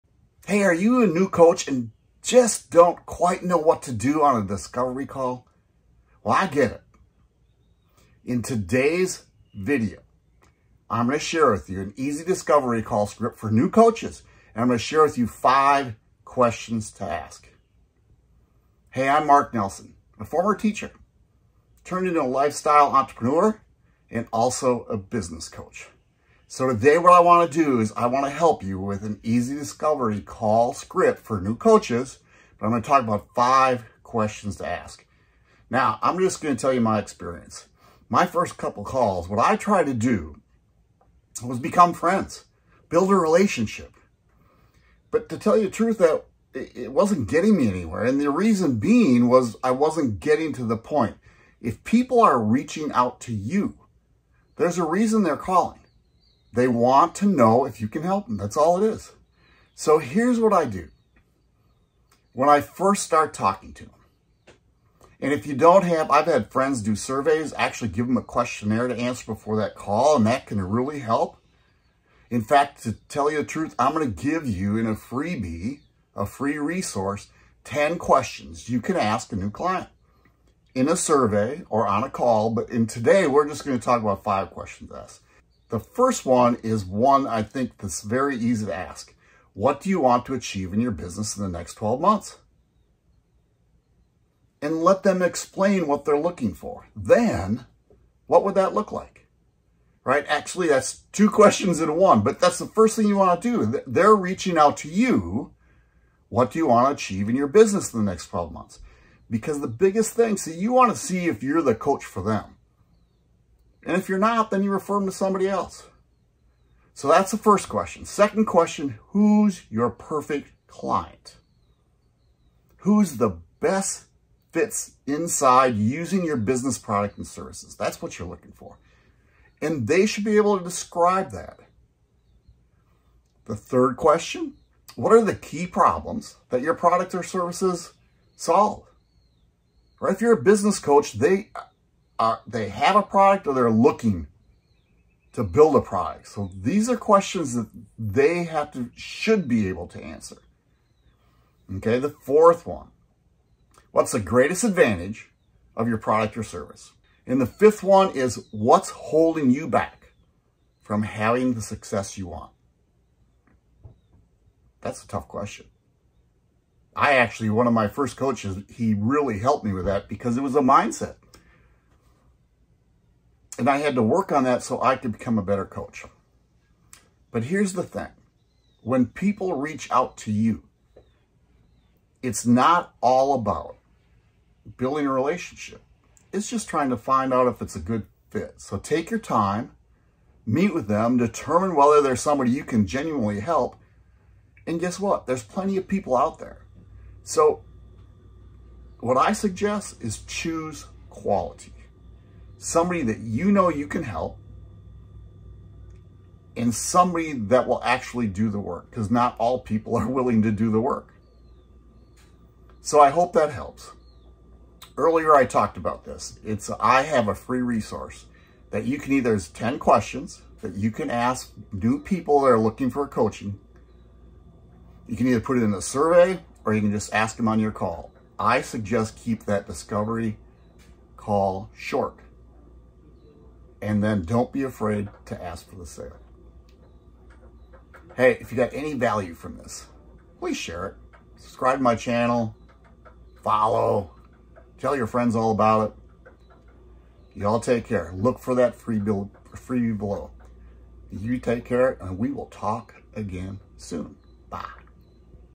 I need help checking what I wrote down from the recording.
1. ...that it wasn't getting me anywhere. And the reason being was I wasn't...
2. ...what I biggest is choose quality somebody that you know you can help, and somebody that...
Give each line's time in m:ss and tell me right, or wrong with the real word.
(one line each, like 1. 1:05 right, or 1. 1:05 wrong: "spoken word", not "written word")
1. 0:45 right
2. 3:19 wrong: "suggest", not "biggest".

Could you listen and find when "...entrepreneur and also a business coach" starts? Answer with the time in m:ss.
0:22.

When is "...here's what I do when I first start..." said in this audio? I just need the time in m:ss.
0:59.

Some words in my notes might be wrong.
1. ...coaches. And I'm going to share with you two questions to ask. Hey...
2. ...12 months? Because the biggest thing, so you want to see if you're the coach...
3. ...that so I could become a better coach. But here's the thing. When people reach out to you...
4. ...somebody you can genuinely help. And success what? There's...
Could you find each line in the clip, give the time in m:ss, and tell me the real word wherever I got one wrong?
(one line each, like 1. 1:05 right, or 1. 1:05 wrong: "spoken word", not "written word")
1. 0:13 wrong: "five", not "two"
2. 1:48 right
3. 2:54 right
4. 3:12 wrong: "guess", not "success".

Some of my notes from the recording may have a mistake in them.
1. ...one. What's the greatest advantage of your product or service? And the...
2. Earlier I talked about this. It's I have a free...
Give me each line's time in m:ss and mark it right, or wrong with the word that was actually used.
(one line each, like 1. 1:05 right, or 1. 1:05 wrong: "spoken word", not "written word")
1. 2:32 right
2. 3:34 right.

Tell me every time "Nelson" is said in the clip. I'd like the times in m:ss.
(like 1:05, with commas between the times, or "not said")
0:19.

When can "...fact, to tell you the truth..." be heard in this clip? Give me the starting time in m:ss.
1:12.